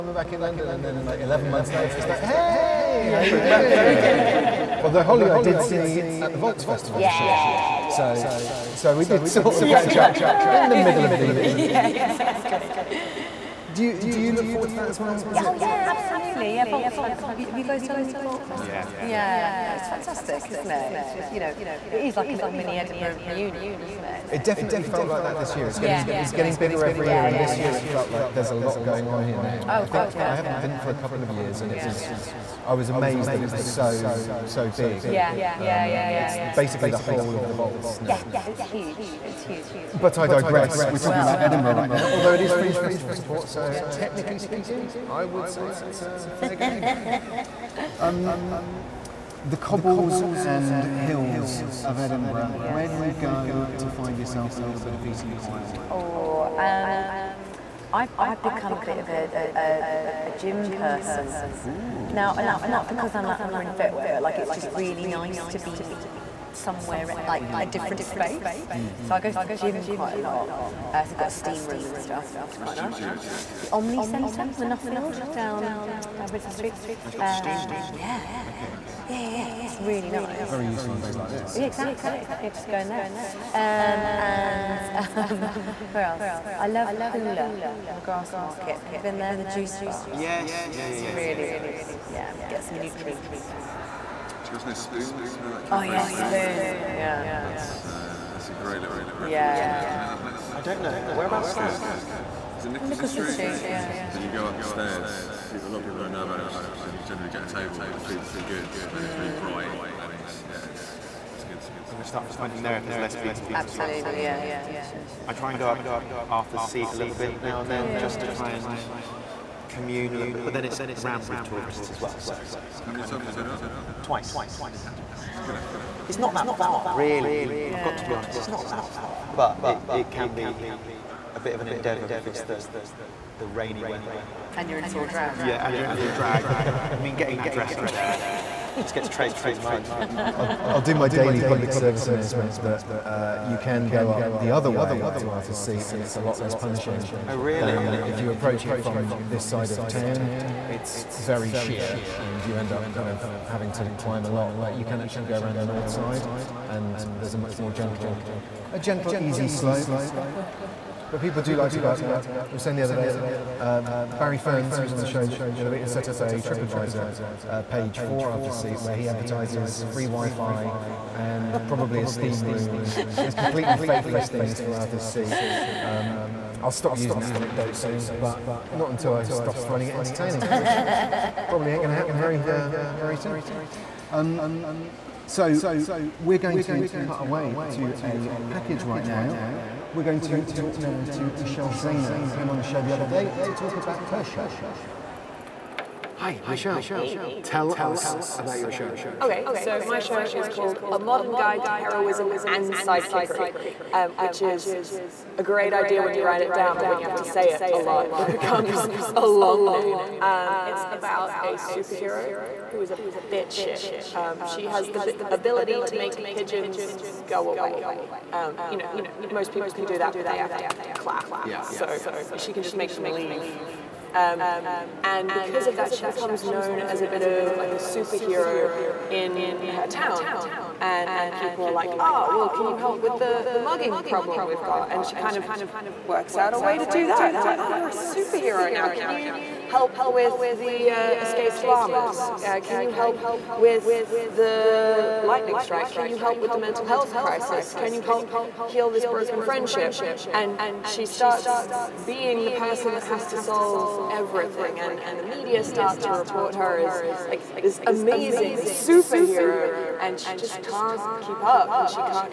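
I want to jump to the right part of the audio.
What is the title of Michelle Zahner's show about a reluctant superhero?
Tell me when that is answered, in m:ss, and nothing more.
3:20.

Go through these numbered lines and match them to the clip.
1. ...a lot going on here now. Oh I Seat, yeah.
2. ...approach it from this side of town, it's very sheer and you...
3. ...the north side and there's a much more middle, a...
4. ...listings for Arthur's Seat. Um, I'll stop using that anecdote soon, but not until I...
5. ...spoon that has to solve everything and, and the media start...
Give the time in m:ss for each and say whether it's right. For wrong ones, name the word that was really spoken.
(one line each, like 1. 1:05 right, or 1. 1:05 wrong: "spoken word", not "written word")
1. 0:28 wrong: "God", not "Seat"
2. 2:28 right
3. 2:35 wrong: "gentle", not "middle"
4. 2:54 right
5. 4:12 wrong: "person", not "spoon".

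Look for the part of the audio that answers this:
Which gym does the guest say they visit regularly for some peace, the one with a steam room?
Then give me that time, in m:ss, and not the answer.
1:14.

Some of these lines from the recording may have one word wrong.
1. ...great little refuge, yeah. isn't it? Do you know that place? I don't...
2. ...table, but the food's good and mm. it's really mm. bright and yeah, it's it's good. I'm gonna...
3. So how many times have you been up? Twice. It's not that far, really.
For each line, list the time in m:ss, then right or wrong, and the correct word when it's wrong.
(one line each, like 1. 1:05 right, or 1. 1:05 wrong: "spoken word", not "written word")
1. 1:38 right
2. 1:47 right
3. 2:02 right.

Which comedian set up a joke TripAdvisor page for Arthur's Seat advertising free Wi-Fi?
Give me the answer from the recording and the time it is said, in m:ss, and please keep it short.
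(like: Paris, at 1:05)
Barry Ferns, at 2:44.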